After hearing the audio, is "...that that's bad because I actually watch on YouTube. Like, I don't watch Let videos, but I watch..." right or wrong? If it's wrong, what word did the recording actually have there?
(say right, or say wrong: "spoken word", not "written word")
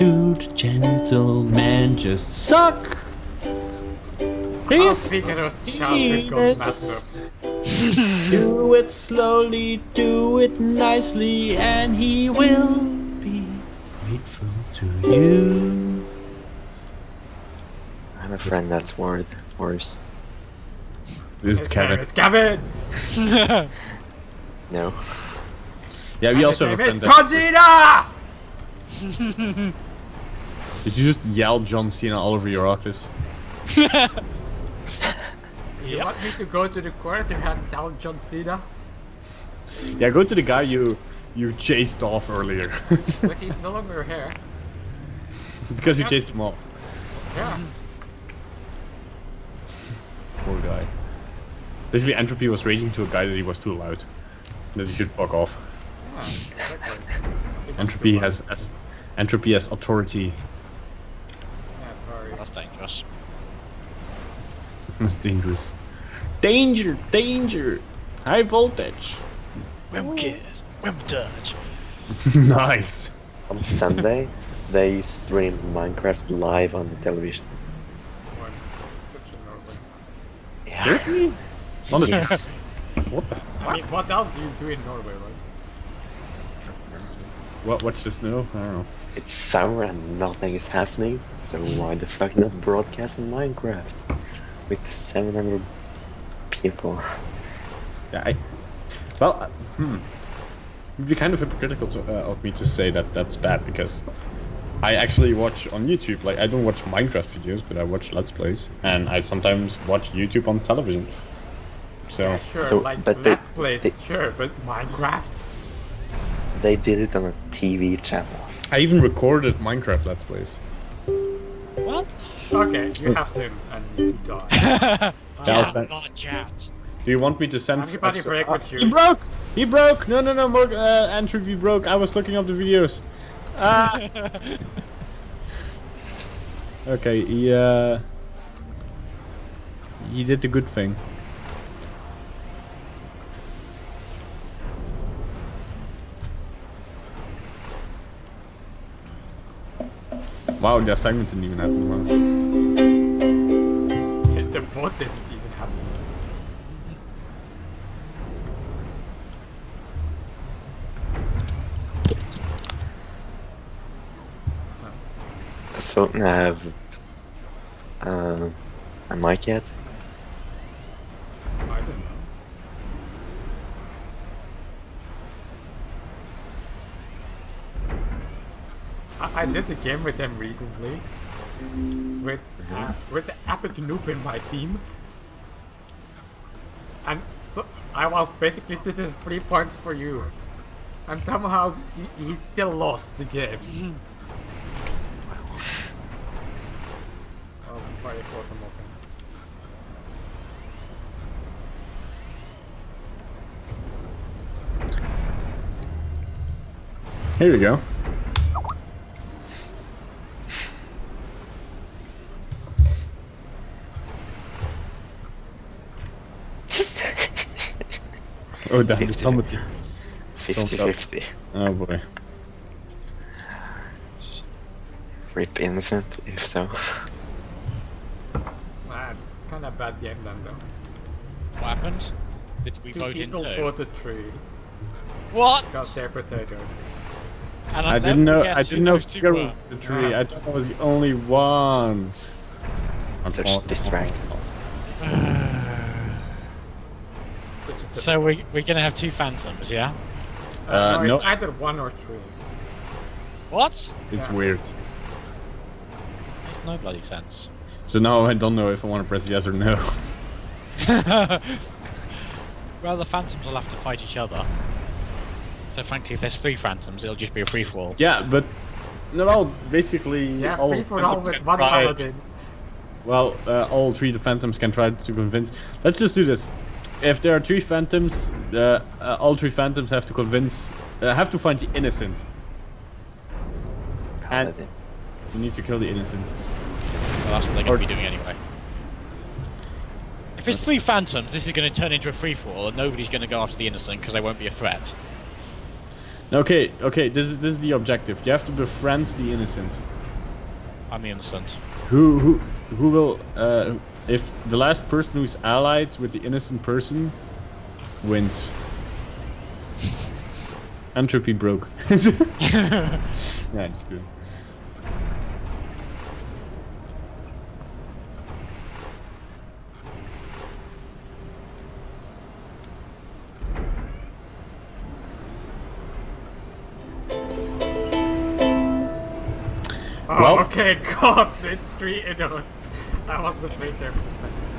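wrong: "Minecraft", not "Let".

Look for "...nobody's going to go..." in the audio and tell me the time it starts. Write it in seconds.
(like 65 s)
292 s.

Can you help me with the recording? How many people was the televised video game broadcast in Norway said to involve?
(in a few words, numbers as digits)
700.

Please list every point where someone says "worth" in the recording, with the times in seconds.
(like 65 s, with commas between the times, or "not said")
18 s.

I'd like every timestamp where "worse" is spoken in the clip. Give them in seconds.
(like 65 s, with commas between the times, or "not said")
19 s.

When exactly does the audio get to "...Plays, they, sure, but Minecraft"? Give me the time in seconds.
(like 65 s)
113 s.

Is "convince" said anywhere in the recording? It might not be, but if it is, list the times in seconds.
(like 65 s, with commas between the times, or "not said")
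275 s, 280 s.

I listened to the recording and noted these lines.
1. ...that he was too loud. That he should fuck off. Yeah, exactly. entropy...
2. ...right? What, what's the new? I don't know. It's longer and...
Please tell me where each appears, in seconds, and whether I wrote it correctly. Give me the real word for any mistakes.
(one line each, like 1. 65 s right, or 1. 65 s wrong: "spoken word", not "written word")
1. 53 s right
2. 85 s wrong: "summer", not "longer".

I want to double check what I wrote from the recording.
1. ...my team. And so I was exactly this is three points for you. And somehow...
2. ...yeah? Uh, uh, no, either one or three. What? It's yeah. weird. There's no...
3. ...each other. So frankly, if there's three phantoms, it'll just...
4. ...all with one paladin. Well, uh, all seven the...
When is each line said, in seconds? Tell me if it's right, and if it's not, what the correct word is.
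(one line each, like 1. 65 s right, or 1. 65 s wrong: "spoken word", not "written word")
1. 184 s wrong: "basically", not "exactly"
2. 249 s right
3. 264 s right
4. 271 s wrong: "three", not "seven".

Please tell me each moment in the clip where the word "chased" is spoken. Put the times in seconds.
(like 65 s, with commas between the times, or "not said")
41 s, 46 s.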